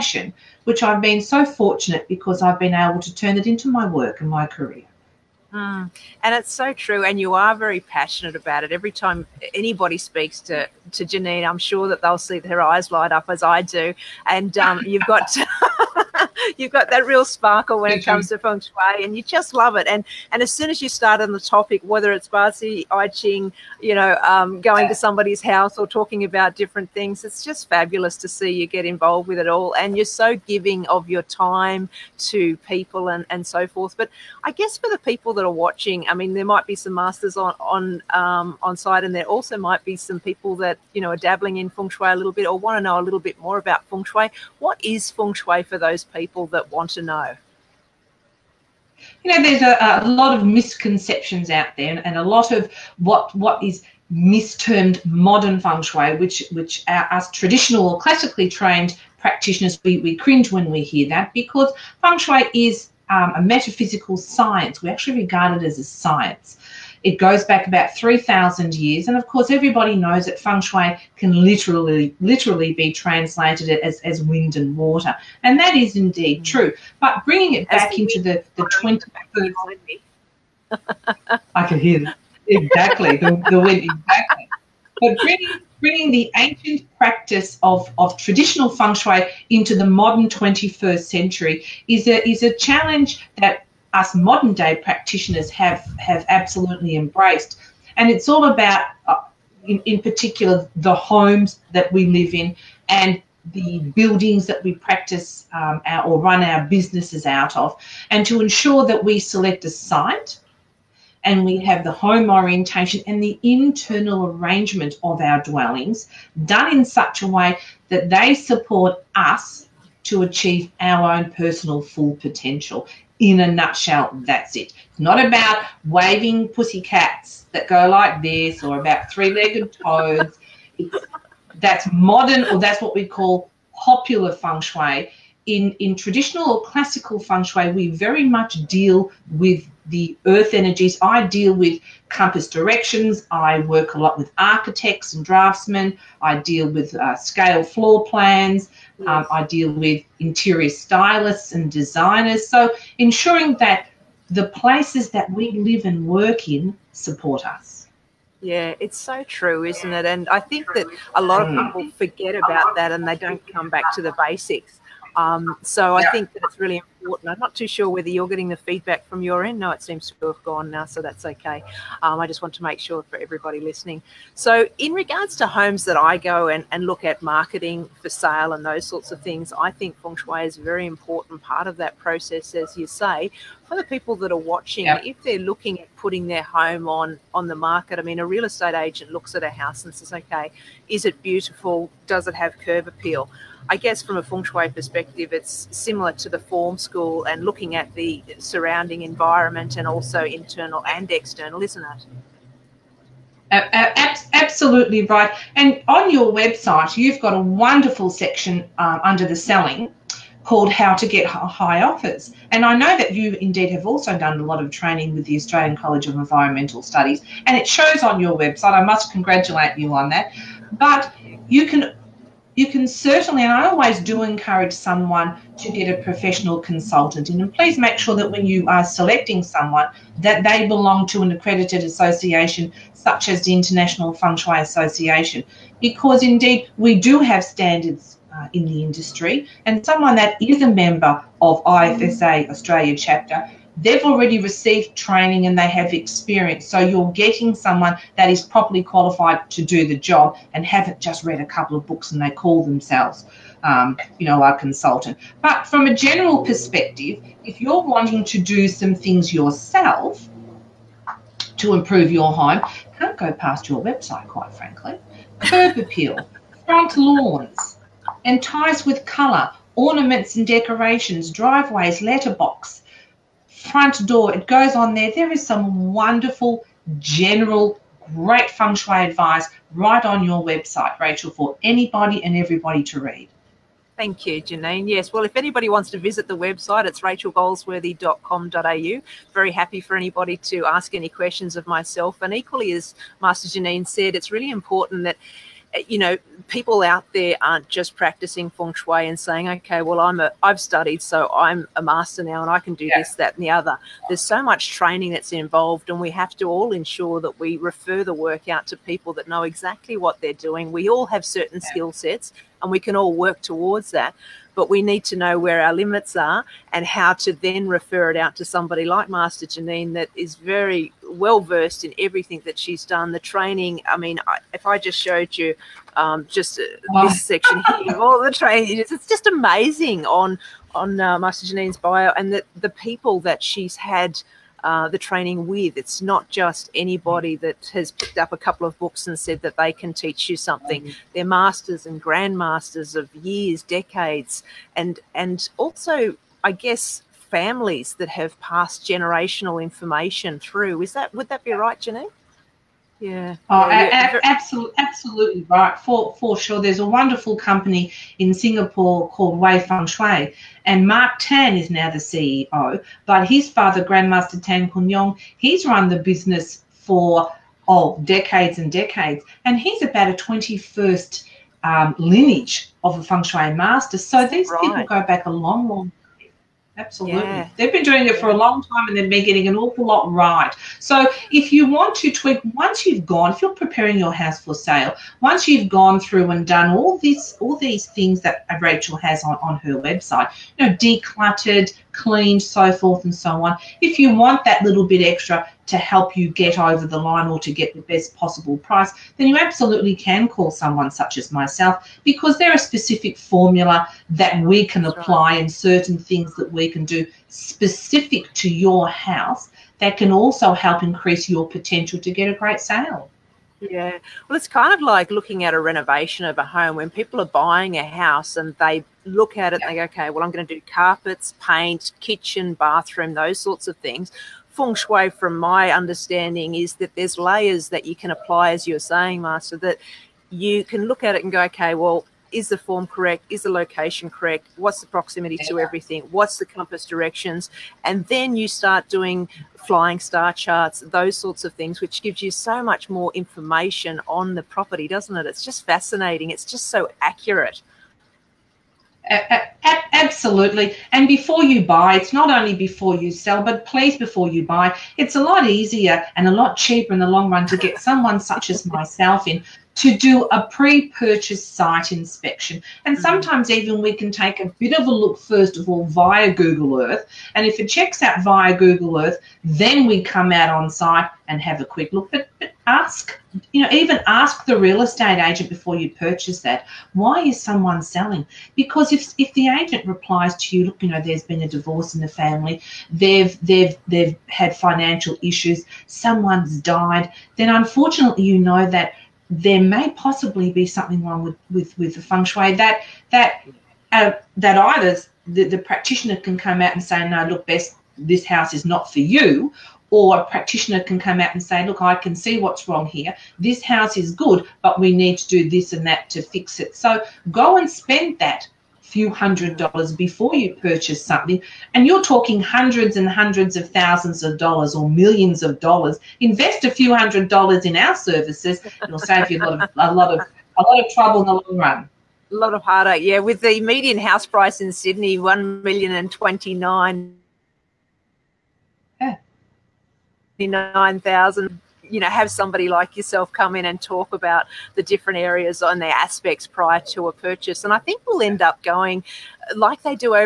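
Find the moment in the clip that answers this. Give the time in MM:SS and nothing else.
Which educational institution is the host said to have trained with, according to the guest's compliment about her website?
03:35.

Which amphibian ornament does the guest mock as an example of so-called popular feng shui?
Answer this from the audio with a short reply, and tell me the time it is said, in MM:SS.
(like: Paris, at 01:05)
three legged toads, at 02:09.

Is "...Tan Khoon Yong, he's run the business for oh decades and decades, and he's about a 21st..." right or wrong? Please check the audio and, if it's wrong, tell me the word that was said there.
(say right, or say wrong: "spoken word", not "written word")
right.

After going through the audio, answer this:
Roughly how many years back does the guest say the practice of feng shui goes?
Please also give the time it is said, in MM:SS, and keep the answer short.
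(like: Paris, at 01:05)
3,000 years, at 01:07.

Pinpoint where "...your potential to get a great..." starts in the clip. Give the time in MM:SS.
06:51.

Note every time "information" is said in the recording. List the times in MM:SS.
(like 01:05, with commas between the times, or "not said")
05:49, 07:23.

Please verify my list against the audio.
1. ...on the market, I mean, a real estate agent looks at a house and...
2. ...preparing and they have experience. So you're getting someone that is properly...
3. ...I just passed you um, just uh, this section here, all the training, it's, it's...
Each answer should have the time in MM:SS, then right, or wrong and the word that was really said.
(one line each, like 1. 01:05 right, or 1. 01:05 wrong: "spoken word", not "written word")
1. 03:07 right
2. 04:04 wrong: "training", not "preparing"
3. 05:24 wrong: "showed", not "passed".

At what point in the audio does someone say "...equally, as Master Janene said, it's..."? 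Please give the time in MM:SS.
04:52.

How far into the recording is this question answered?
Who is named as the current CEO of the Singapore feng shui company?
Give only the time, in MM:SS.
06:00.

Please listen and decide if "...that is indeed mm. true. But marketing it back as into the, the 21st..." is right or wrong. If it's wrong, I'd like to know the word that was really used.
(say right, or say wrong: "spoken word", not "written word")
wrong: "bringing", not "marketing".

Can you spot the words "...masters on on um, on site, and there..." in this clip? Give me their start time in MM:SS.
00:36.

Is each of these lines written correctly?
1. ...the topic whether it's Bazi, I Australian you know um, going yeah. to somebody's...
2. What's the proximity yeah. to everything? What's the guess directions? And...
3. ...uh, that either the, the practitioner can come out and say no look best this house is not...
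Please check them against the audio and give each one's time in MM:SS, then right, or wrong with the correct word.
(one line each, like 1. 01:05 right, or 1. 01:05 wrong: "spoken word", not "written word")
1. 00:21 wrong: "Ching", not "Australian"
2. 07:14 wrong: "compass", not "guess"
3. 08:13 right.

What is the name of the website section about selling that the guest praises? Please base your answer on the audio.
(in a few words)
How to Get High Offers.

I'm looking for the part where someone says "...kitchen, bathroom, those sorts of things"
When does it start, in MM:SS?
07:02.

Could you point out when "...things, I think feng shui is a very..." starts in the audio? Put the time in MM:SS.
02:59.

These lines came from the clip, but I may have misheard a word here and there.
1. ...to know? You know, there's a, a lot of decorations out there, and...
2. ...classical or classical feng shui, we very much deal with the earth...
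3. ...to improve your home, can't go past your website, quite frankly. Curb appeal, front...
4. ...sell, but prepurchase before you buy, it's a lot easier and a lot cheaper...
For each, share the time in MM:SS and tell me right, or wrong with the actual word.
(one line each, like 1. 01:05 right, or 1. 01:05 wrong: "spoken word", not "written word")
1. 00:46 wrong: "misconceptions", not "decorations"
2. 02:15 wrong: "traditional", not "classical"
3. 04:21 right
4. 07:33 wrong: "please", not "prepurchase".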